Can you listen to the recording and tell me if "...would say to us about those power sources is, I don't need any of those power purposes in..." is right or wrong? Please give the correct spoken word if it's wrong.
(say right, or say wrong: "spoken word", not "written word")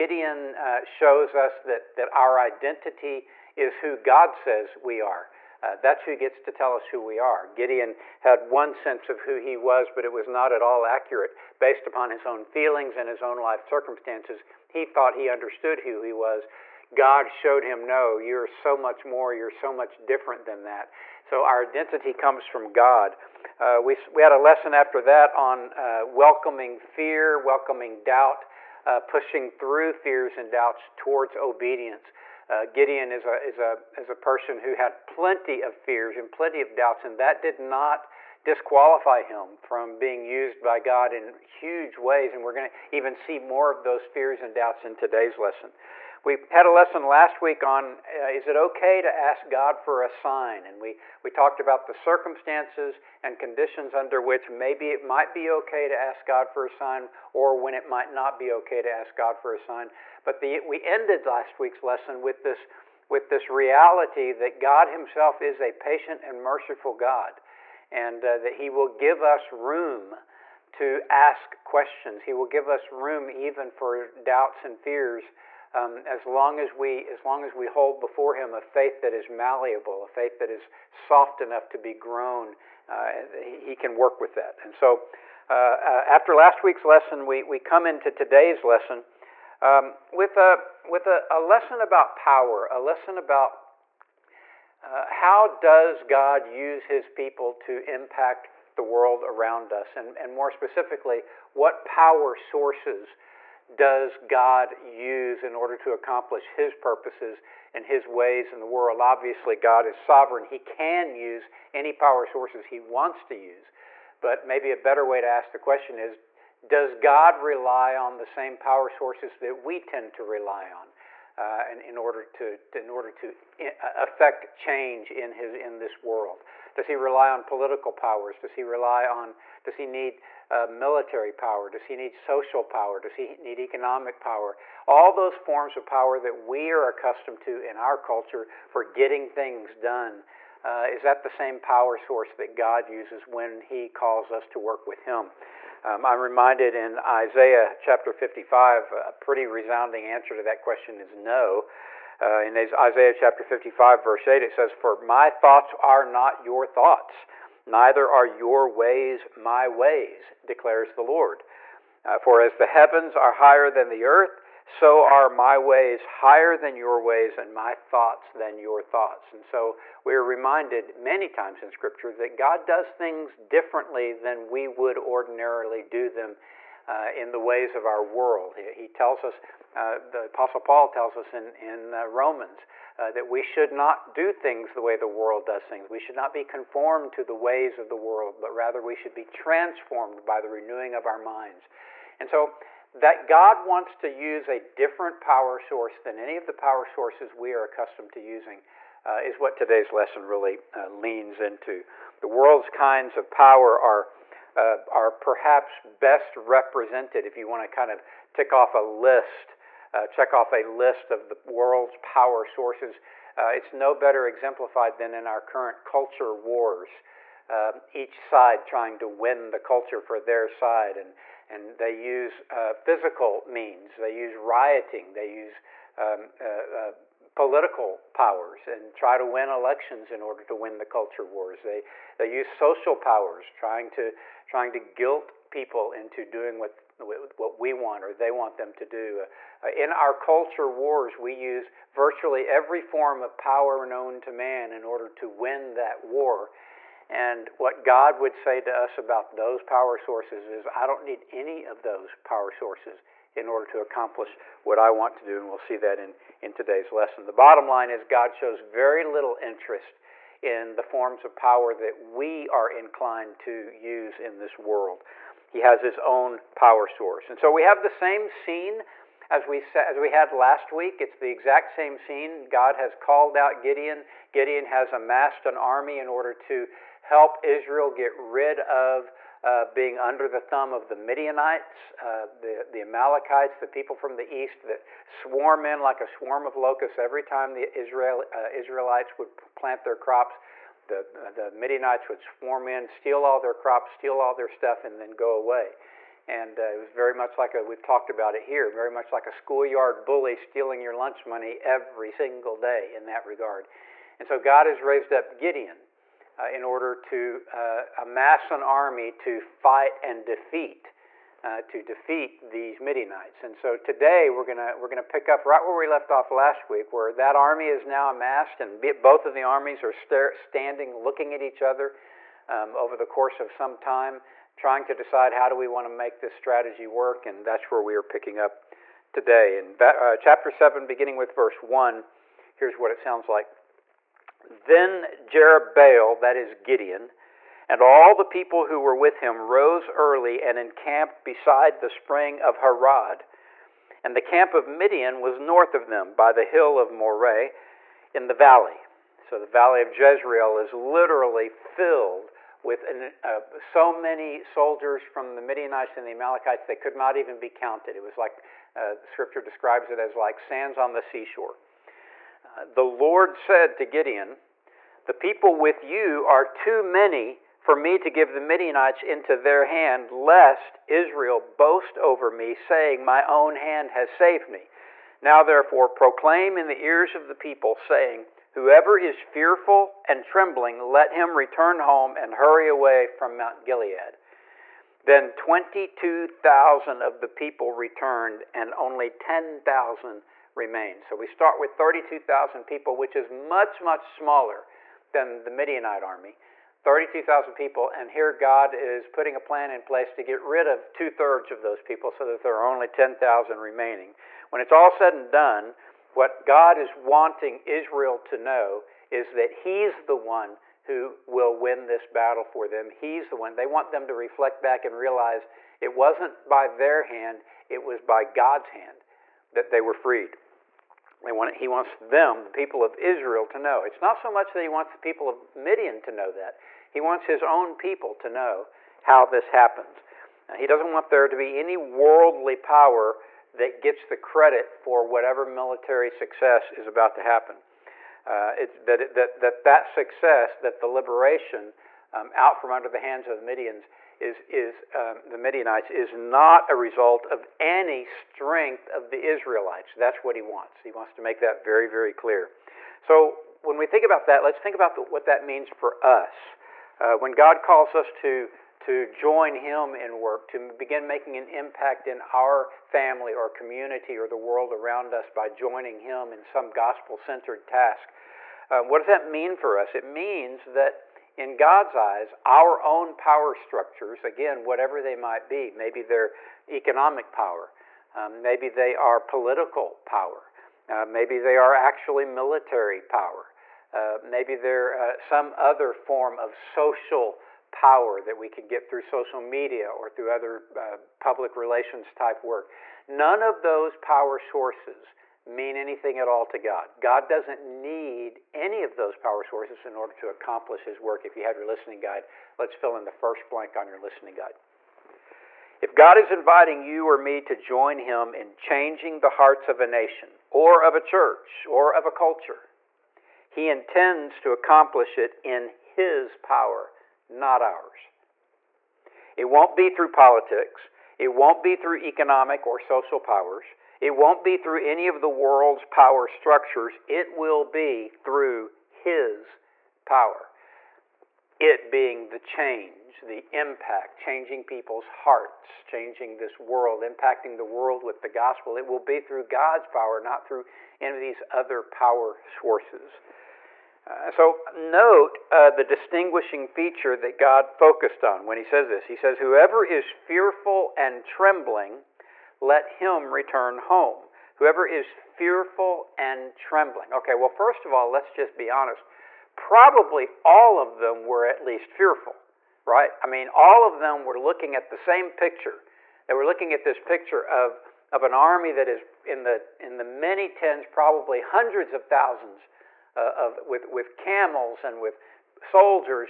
wrong: "sources", not "purposes".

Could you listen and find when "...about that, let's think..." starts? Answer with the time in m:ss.
7:34.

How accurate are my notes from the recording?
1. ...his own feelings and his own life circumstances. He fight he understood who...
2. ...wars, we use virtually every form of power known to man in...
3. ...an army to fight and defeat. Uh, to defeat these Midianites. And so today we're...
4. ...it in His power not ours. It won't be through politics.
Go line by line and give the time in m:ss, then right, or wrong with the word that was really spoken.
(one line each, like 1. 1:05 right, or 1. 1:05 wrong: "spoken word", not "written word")
1. 0:12 wrong: "thought", not "fight"
2. 4:00 right
3. 5:08 right
4. 8:35 right.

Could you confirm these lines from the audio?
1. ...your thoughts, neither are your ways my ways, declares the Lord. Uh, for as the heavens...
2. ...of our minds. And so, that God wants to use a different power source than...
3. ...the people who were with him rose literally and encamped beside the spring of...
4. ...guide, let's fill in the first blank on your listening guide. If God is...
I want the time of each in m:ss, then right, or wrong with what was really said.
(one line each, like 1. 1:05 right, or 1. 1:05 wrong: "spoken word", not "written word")
1. 2:36 right
2. 3:10 right
3. 5:38 wrong: "early", not "literally"
4. 8:21 right.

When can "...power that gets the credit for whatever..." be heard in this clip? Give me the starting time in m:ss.
7:12.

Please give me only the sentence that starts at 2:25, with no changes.
Um, I'm reminded in Isaiah chapter 55, a pretty resounding answer to that question is no.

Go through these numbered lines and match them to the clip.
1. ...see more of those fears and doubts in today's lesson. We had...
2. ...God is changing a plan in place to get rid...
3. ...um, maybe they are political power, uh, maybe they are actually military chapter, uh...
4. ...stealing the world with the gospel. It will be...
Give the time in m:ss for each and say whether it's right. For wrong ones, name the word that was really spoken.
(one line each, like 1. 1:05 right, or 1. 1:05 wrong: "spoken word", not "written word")
1. 0:43 right
2. 6:38 wrong: "putting", not "changing"
3. 7:58 wrong: "power", not "chapter"
4. 8:57 wrong: "impacting", not "stealing".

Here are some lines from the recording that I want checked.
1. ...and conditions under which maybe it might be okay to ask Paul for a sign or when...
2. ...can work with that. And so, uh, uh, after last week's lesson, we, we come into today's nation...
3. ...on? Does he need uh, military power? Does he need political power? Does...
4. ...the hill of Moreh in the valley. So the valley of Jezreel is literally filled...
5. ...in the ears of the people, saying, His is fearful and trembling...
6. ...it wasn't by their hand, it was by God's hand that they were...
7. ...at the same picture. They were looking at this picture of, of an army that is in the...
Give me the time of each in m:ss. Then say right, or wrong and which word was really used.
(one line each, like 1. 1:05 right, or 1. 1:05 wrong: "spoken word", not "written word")
1. 0:53 wrong: "God", not "Paul"
2. 1:23 wrong: "lesson", not "nation"
3. 2:09 wrong: "social", not "political"
4. 5:46 right
5. 6:16 wrong: "Whoever", not "His"
6. 6:55 right
7. 9:24 right.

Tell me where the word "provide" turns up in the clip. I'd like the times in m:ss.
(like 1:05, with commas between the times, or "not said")
not said.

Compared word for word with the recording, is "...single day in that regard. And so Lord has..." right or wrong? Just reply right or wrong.
wrong.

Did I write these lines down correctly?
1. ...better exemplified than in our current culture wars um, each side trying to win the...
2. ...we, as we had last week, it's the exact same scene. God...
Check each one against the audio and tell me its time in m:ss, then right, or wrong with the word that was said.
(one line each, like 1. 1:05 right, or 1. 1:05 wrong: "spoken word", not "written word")
1. 3:33 right
2. 4:29 right.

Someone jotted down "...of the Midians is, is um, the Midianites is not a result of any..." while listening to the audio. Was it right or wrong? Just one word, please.
right.